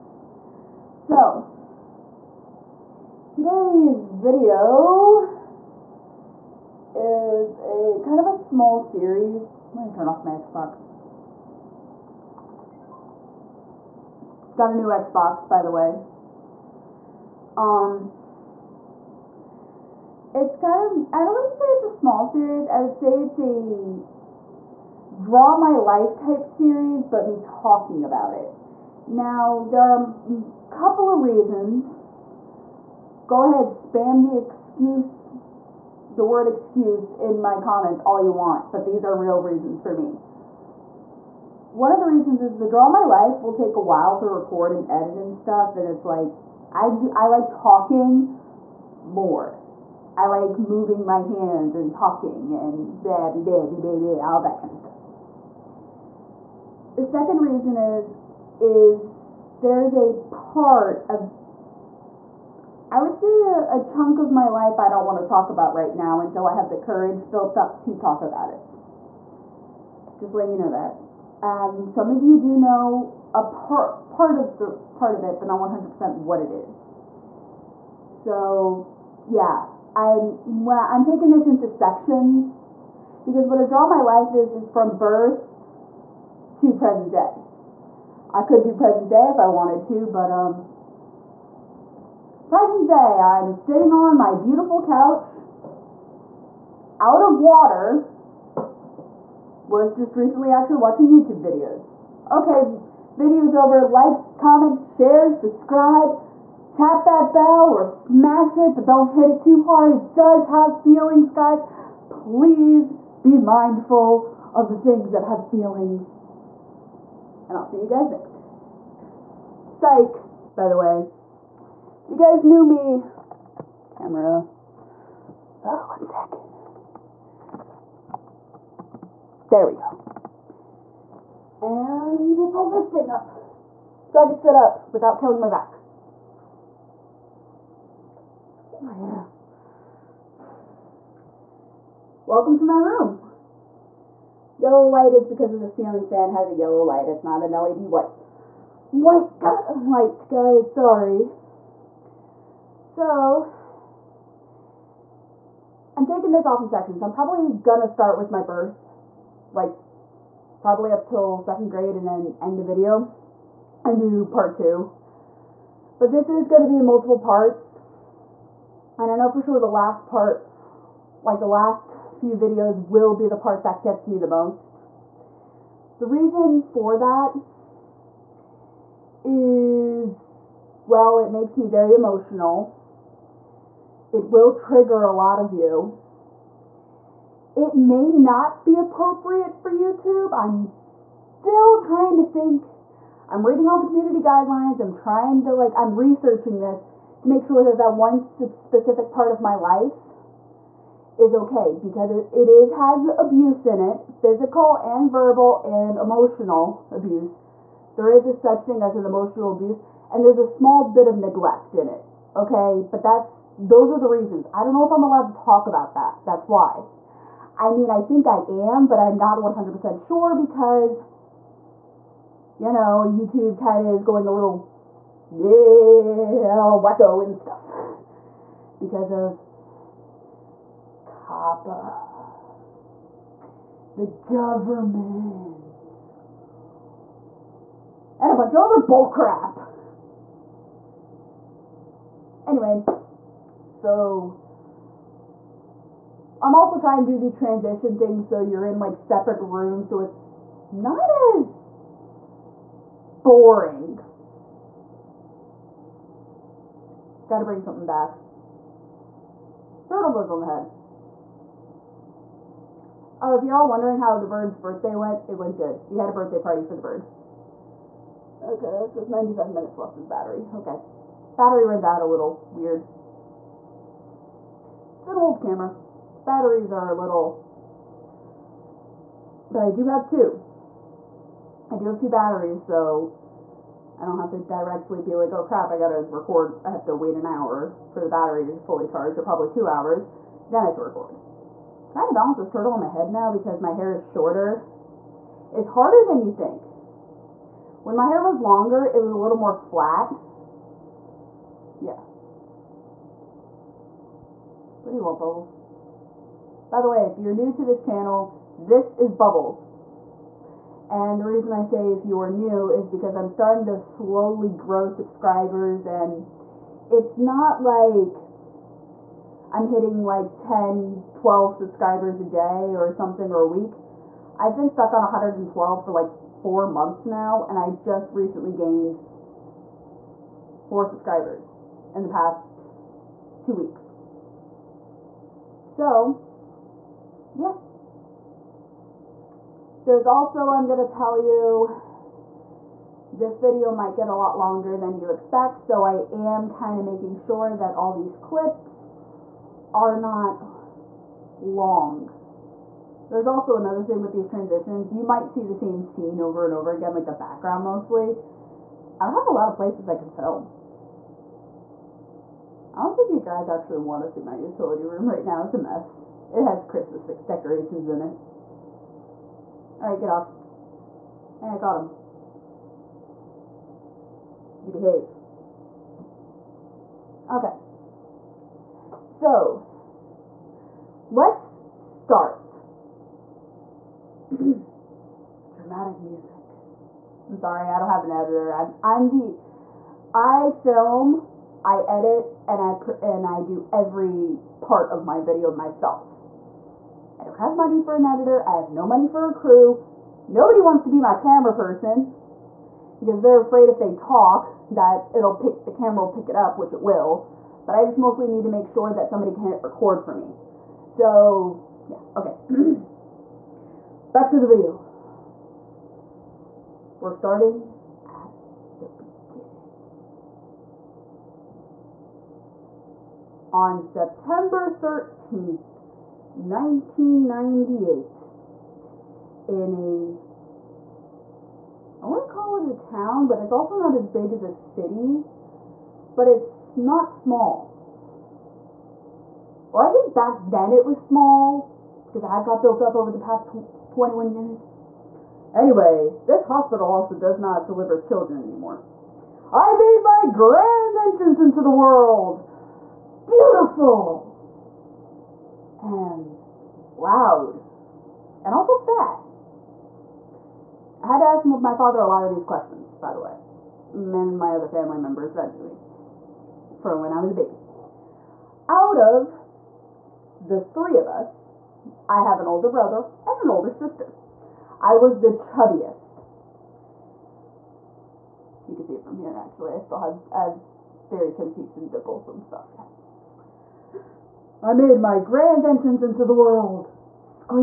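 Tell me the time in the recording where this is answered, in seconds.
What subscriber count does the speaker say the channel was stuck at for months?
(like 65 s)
325 s.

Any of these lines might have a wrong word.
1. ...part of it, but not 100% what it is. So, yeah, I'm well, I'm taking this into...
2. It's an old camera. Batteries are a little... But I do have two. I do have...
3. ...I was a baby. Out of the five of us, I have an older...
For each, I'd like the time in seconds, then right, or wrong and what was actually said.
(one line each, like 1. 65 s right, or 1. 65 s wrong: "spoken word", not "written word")
1. 74 s right
2. 274 s right
3. 467 s wrong: "three", not "five".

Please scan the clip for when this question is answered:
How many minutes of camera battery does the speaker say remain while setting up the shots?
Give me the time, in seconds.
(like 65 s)
269 s.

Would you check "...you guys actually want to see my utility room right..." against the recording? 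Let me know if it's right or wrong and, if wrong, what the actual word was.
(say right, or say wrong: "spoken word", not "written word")
right.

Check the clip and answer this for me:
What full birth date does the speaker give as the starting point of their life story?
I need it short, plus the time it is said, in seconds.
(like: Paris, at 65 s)
September 13th, 1998, at 423 s.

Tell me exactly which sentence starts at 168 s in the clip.
And I know for sure the last part, like the last few videos will be the part that gets me the most.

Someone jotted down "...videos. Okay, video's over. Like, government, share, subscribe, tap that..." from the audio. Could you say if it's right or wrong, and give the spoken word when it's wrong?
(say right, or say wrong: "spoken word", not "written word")
wrong: "comment", not "government".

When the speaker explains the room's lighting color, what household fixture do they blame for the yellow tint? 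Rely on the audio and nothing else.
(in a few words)
ceiling fan.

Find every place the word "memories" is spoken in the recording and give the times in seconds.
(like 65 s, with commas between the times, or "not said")
not said.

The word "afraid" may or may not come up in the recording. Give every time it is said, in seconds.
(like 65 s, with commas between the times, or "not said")
403 s.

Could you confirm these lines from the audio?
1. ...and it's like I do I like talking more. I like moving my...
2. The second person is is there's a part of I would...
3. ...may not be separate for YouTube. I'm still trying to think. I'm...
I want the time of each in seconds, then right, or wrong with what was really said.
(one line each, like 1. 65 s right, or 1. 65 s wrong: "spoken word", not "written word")
1. 45 s right
2. 56 s wrong: "reason", not "person"
3. 187 s wrong: "appropriate", not "separate".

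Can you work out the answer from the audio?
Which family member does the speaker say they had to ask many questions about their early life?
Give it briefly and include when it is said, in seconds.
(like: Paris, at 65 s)
father, at 461 s.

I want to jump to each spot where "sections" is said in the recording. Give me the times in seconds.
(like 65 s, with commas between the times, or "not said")
81 s, 156 s.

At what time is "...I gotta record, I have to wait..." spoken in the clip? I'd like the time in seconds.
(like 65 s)
285 s.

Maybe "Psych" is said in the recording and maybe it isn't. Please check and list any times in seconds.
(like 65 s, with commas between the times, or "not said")
119 s.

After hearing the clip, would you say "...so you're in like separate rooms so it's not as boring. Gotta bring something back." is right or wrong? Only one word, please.
right.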